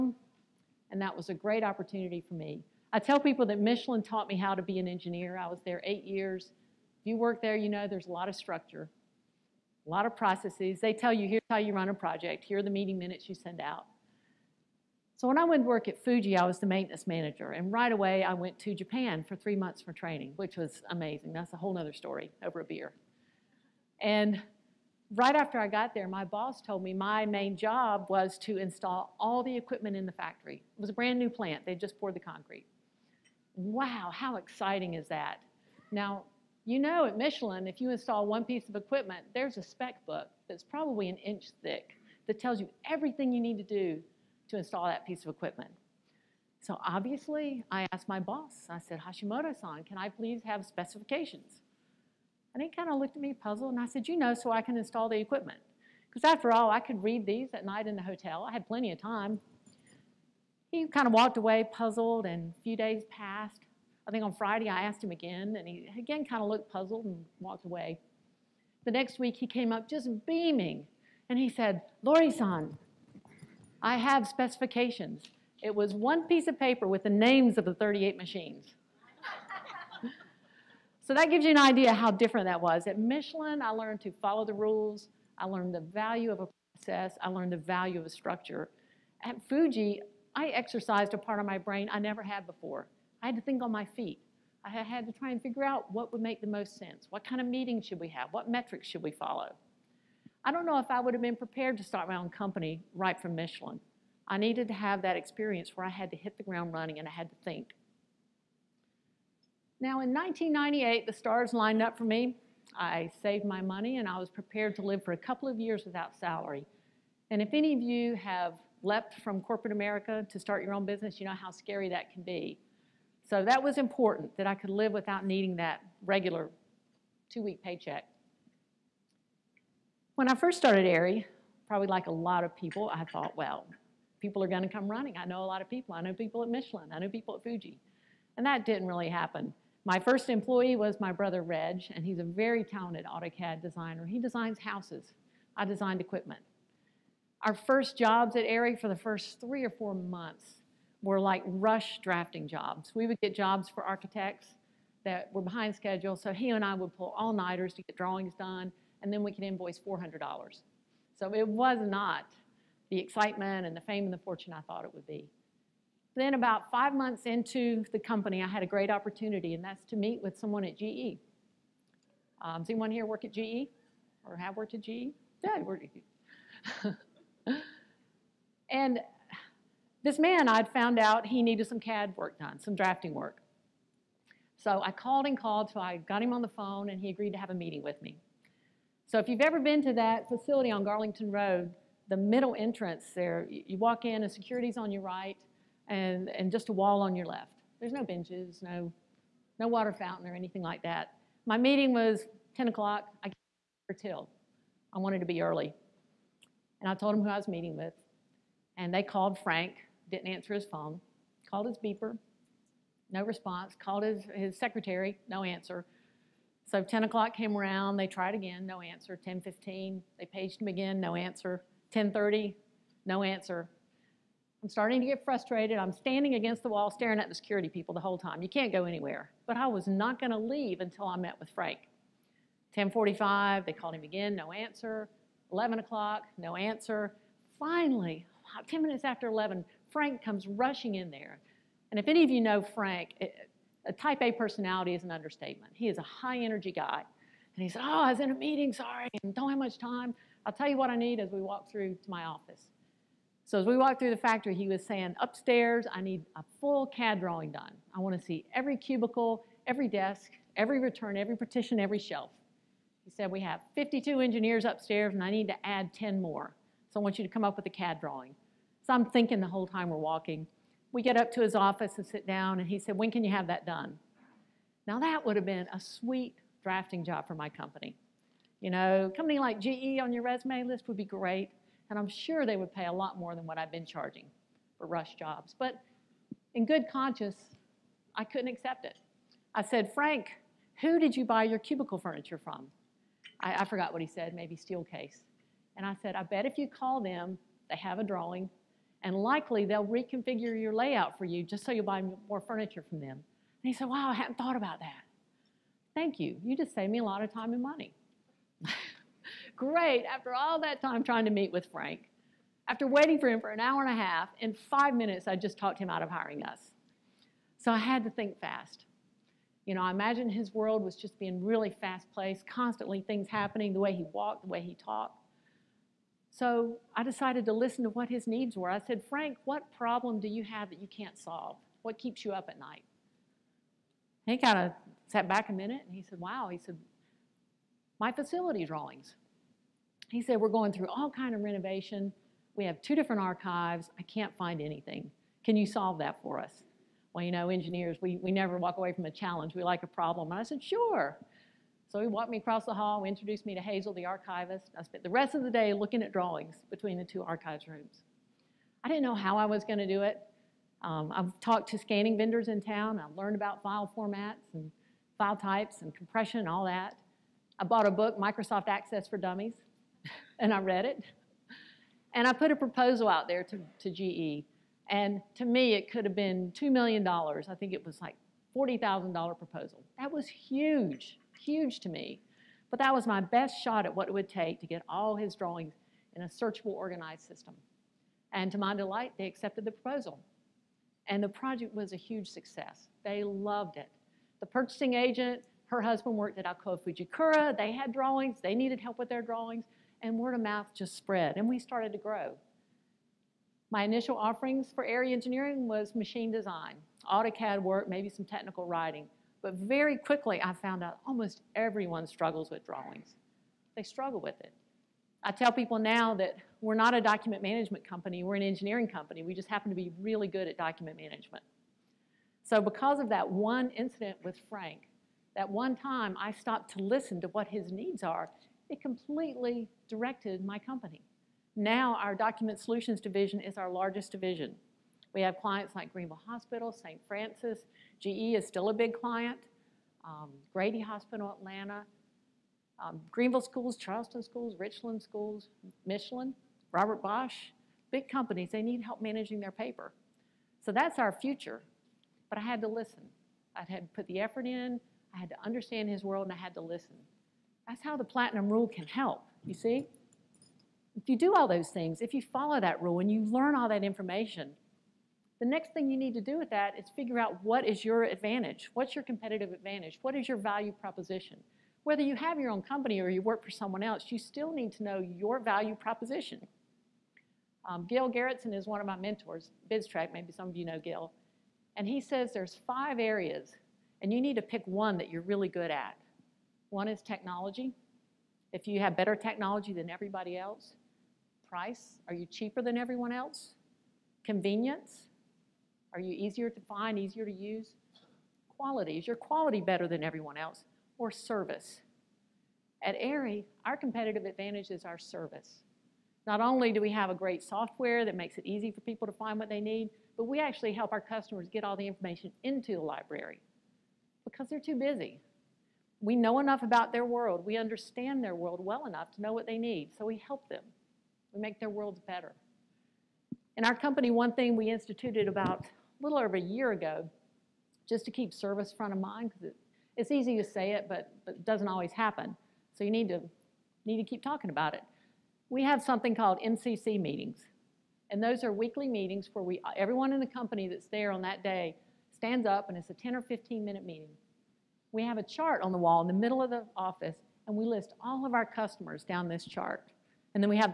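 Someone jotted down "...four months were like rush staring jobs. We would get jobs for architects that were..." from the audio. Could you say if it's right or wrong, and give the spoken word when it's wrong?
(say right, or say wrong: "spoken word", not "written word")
wrong: "drafting", not "staring".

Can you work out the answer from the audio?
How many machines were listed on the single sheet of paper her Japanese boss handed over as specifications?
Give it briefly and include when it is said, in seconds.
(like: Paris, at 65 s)
38, at 77 s.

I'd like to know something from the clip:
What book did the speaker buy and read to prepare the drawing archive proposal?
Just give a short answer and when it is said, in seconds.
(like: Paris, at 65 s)
Microsoft Access for Dummies, at 368 s.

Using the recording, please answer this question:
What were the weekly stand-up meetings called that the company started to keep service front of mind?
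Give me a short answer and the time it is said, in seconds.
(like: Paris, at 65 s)
MCC meetings, at 536 s.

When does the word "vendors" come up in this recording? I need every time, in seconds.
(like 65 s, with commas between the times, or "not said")
362 s.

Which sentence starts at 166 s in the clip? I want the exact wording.
Then about five months into the company, I had a great opportunity, and that's to meet with someone at GE.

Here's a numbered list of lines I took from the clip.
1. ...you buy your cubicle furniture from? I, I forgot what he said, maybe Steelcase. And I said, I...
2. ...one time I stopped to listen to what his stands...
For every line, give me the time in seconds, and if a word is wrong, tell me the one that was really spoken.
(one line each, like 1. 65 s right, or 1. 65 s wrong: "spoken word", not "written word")
1. 291 s right
2. 425 s wrong: "needs", not "stands".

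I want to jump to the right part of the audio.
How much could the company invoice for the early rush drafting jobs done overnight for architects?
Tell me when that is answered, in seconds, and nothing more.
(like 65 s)
159 s.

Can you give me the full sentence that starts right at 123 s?
So that was important that I could live without needing that regular two week paycheck.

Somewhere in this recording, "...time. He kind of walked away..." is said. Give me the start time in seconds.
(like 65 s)
58 s.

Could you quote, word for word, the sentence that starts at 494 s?
Convenience, are you easier to find, easier to use?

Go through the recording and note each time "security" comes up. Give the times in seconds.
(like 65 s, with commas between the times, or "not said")
194 s, 227 s.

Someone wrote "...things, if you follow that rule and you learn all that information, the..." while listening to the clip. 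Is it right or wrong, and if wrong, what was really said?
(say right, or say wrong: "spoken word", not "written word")
right.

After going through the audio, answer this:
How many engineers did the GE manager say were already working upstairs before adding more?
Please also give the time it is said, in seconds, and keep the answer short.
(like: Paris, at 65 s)
52, at 263 s.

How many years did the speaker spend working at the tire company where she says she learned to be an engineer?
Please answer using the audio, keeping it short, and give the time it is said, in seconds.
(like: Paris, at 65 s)
8, at 5 s.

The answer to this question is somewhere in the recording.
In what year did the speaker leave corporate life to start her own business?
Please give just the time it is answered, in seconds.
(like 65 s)
110 s.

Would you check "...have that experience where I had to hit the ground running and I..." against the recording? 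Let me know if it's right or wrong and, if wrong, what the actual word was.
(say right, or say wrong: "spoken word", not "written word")
right.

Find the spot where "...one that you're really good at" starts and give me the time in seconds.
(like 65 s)
484 s.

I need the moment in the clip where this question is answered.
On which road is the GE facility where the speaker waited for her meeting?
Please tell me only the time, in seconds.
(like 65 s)
190 s.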